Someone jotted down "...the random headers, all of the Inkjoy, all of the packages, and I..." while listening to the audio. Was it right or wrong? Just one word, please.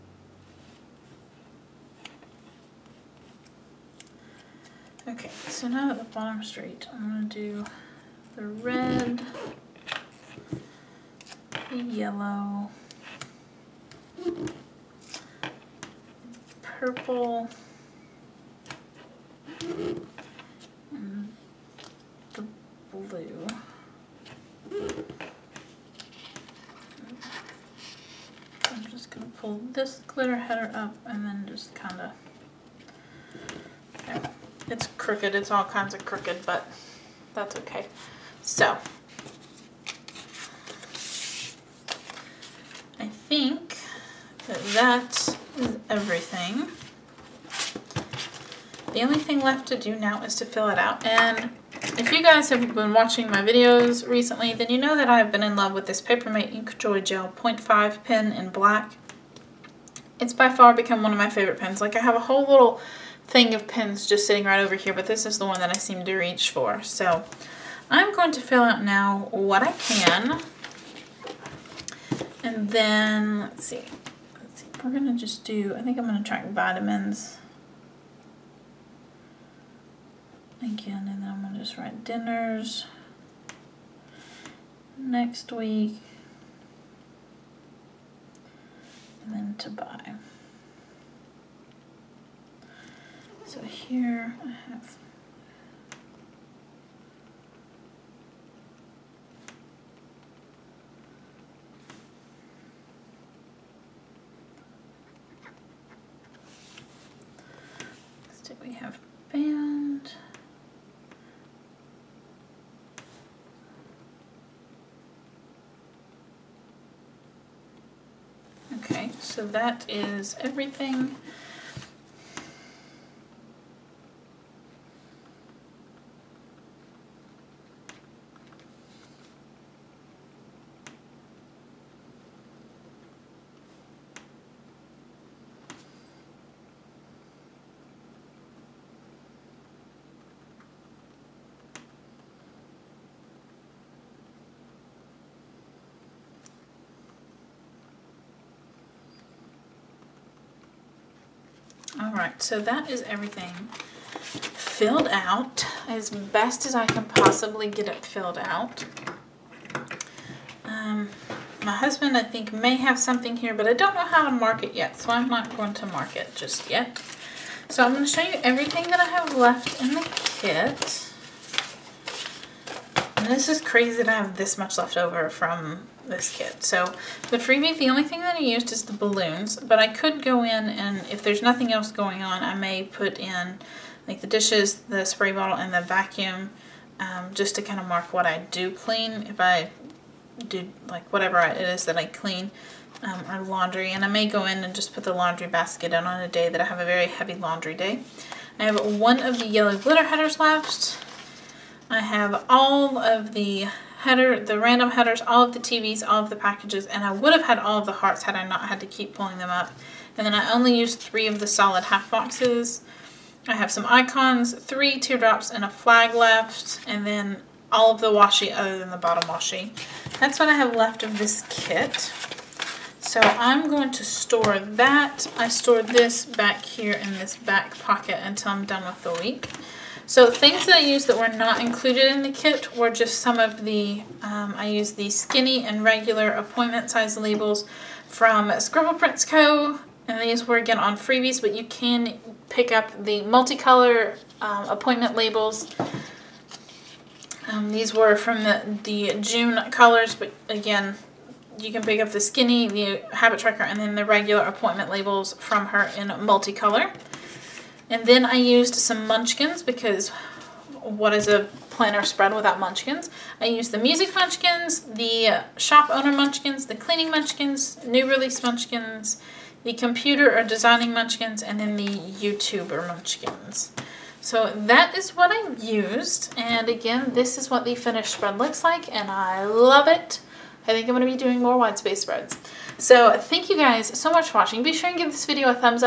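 wrong.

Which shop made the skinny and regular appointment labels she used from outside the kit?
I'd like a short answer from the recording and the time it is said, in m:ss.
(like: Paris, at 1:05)
Scribble Prints Co., at 3:58.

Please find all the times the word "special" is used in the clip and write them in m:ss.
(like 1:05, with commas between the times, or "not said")
not said.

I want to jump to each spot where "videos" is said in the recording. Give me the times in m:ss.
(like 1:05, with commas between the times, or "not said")
0:53, 4:45.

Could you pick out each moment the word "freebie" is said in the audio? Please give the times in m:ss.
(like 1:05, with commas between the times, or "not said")
2:57, 4:00.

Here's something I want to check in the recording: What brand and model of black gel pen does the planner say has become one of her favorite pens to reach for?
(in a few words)
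Papermate Inkjoy Gel.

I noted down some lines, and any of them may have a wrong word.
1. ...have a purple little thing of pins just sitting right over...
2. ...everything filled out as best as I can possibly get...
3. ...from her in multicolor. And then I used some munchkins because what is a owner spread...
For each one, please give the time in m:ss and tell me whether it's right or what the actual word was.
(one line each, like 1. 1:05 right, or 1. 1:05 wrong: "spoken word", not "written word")
1. 1:02 wrong: "whole", not "purple"
2. 2:33 right
3. 4:15 wrong: "planner", not "owner".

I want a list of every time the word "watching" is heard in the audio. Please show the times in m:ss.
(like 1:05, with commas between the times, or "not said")
0:52, 4:44.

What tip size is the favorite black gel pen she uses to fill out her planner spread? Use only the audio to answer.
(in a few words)
0.5.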